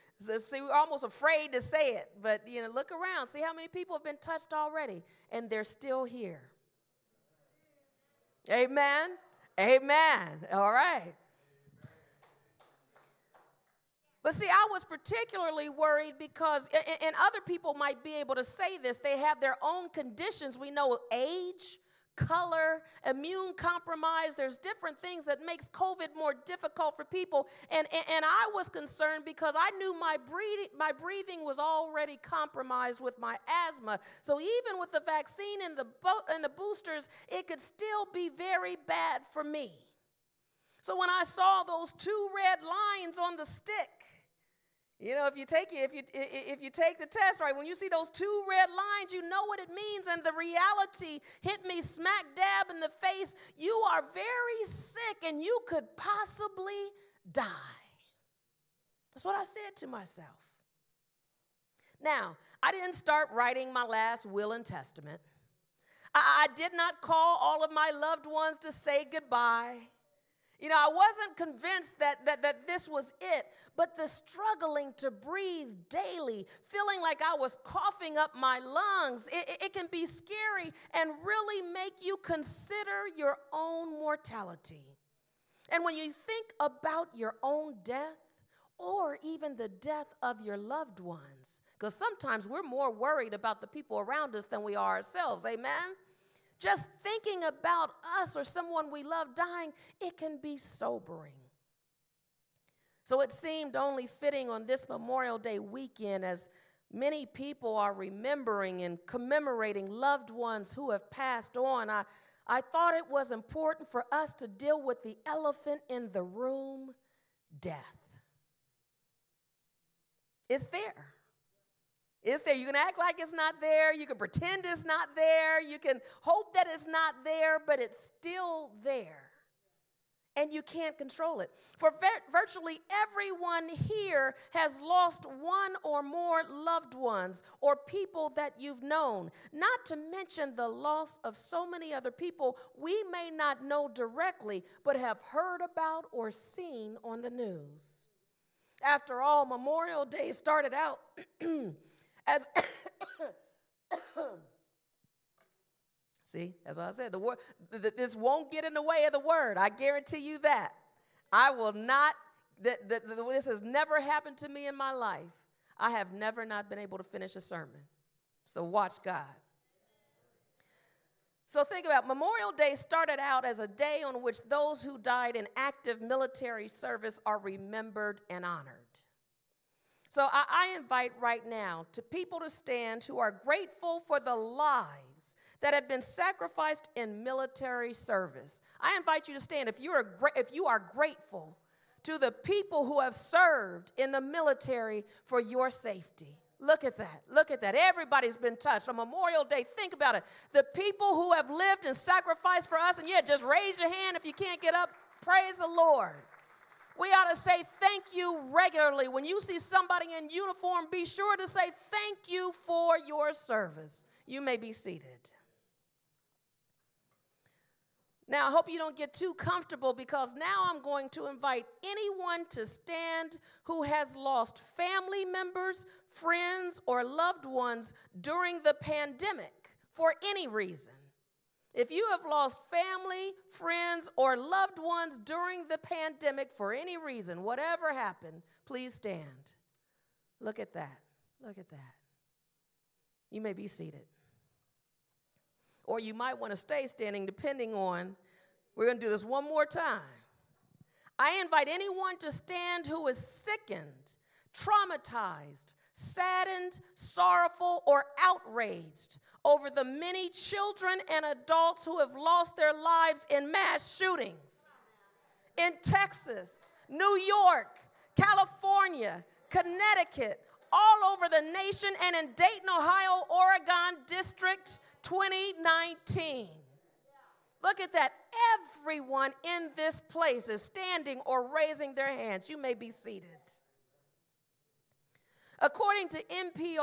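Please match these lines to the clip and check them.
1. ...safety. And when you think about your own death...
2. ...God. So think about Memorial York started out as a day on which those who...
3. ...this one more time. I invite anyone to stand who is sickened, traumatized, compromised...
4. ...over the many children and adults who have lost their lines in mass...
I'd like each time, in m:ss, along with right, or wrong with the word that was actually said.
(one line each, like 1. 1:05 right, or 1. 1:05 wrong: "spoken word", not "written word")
1. 1:23 wrong: "mortality", not "safety"
2. 2:49 wrong: "Day", not "York"
3. 4:09 wrong: "saddened", not "compromised"
4. 4:19 wrong: "lives", not "lines".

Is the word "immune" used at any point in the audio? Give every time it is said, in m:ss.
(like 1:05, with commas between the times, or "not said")
0:23.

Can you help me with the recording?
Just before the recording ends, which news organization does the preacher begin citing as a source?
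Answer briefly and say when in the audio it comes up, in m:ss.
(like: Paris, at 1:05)
NPR, at 4:46.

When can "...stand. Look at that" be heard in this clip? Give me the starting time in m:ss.
3:58.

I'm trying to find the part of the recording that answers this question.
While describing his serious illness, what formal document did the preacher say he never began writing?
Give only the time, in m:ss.
1:03.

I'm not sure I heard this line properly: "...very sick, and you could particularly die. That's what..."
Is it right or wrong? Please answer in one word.
wrong.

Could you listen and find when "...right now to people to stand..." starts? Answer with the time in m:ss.
3:01.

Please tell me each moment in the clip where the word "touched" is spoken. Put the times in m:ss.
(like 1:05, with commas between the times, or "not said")
0:04, 3:18.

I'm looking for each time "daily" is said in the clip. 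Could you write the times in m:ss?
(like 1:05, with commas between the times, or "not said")
1:15.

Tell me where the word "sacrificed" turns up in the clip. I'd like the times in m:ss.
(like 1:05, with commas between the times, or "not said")
3:06, 3:21.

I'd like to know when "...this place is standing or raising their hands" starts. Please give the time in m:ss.
4:39.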